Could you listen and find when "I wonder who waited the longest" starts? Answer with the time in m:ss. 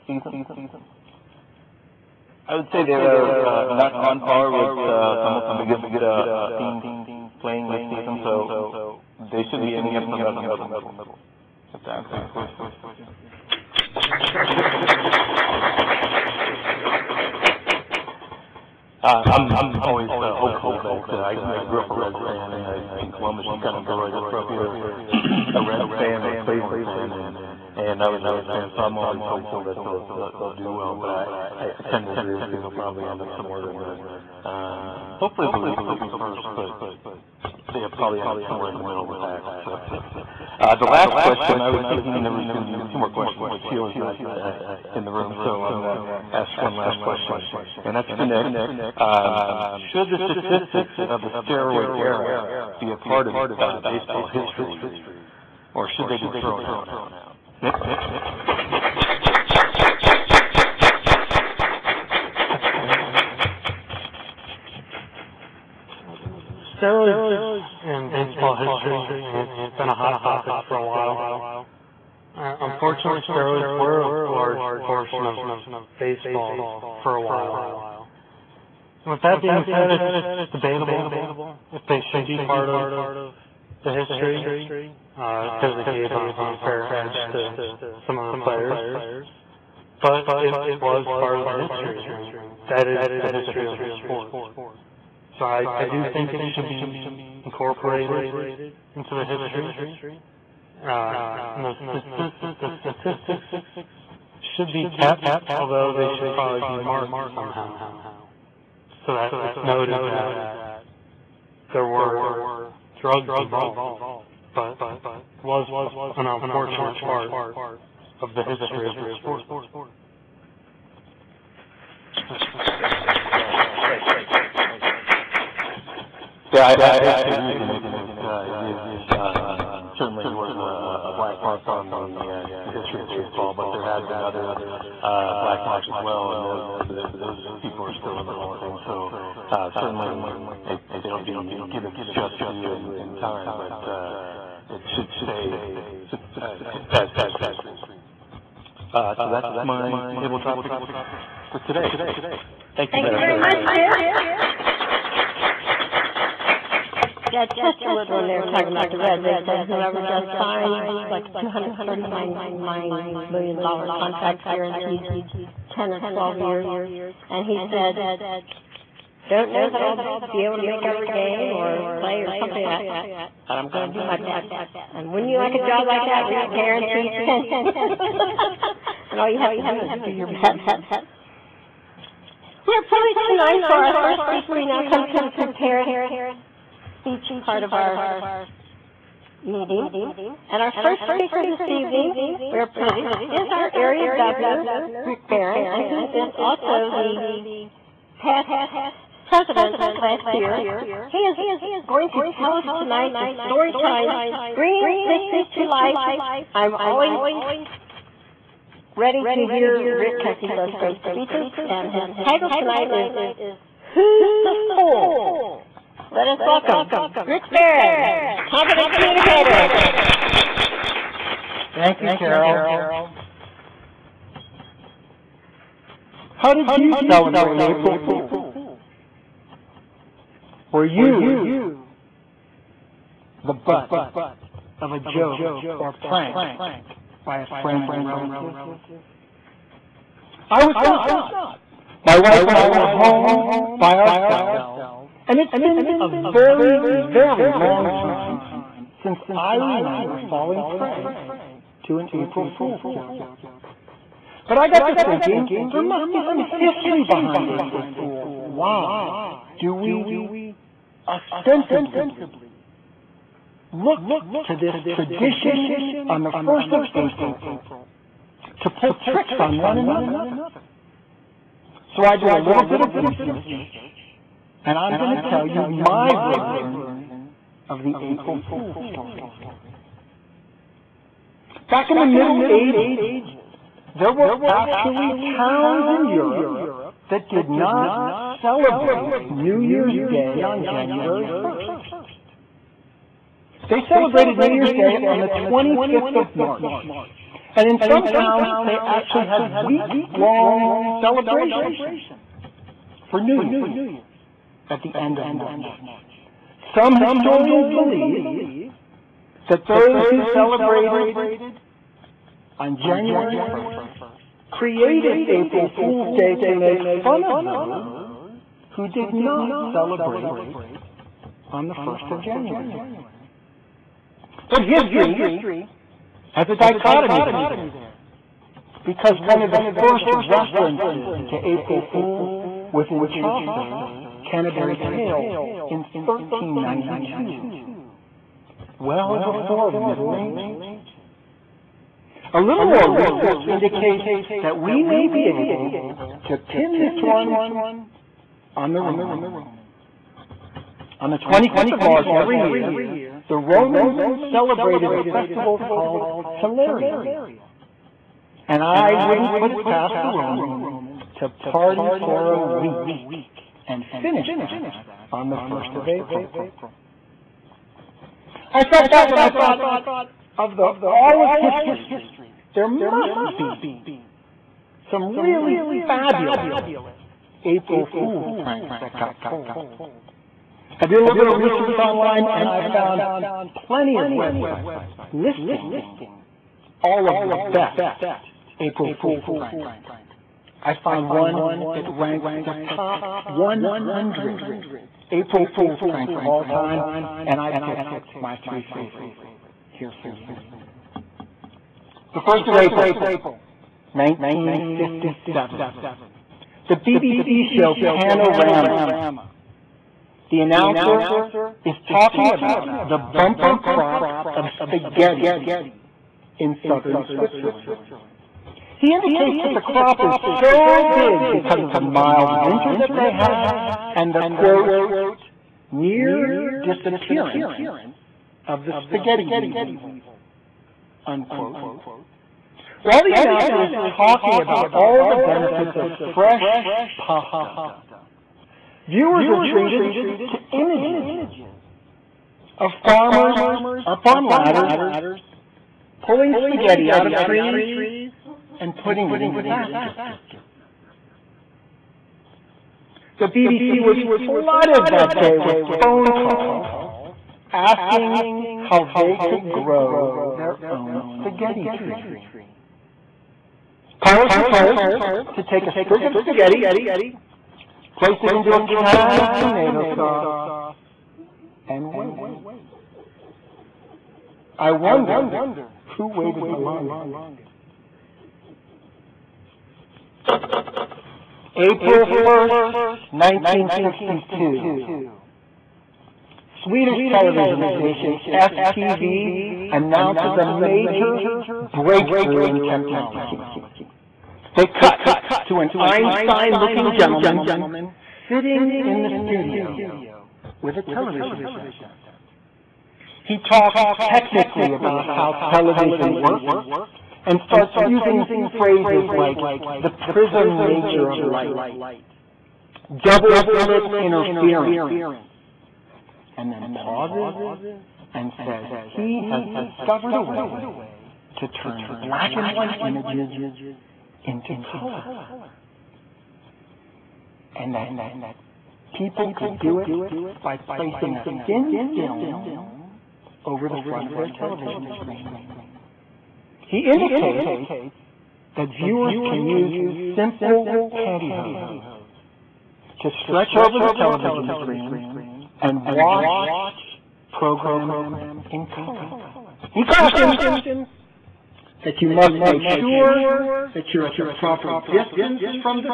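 7:54.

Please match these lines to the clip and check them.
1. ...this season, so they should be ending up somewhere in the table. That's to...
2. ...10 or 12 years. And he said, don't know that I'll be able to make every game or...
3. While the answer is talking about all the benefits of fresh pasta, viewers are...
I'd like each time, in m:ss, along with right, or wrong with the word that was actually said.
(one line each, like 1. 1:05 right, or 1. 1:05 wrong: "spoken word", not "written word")
1. 0:07 wrong: "middle", not "table"
2. 2:45 right
3. 7:12 wrong: "announcer", not "answer".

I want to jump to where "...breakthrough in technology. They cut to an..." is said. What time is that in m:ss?
8:11.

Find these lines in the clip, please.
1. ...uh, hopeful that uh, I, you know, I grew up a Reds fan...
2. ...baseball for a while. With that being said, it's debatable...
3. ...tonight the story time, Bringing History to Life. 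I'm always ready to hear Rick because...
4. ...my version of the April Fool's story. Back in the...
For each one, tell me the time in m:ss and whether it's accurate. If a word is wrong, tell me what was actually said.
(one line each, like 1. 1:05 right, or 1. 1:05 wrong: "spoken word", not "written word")
1. 0:20 right
2. 1:15 right
3. 3:22 right
4. 4:35 right.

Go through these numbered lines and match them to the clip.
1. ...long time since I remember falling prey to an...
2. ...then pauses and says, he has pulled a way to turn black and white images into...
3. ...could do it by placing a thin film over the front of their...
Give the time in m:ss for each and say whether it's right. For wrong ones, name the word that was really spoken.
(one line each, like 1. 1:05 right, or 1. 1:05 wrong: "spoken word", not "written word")
1. 4:07 right
2. 8:36 wrong: "discovered", not "pulled"
3. 8:49 right.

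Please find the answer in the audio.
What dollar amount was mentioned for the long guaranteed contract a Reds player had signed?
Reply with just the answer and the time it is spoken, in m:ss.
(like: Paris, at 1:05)
$239 million, at 2:41.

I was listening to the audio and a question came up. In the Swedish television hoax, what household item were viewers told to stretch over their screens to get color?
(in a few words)
pantyhose.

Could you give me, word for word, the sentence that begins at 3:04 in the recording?
We now come to the prepared speech part of our meeting.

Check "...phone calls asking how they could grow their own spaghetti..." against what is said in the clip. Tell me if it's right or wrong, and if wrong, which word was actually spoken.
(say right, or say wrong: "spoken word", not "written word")
right.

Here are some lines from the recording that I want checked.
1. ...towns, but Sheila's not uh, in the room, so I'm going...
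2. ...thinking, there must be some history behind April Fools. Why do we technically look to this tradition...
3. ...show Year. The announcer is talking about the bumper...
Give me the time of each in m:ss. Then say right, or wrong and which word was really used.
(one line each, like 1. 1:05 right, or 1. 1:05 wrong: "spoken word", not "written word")
1. 0:43 wrong: "questions", not "towns"
2. 4:15 wrong: "ostensibly", not "technically"
3. 6:47 wrong: "Panorama", not "Year".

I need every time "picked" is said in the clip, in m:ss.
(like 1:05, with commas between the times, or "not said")
6:37.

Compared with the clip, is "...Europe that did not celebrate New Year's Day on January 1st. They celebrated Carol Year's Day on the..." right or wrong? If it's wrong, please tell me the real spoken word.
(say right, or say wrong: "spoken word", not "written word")
wrong: "New", not "Carol".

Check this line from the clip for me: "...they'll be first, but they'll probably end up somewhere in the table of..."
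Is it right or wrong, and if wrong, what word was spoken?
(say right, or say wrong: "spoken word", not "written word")
wrong: "middle", not "table".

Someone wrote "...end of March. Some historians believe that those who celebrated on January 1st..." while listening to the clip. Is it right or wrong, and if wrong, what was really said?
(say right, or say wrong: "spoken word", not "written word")
right.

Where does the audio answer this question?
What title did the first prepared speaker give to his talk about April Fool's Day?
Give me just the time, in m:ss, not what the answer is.
3:33.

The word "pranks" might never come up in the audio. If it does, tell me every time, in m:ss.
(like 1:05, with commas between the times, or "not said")
3:56, 6:18, 6:29, 6:35.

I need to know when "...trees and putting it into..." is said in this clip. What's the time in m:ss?
7:27.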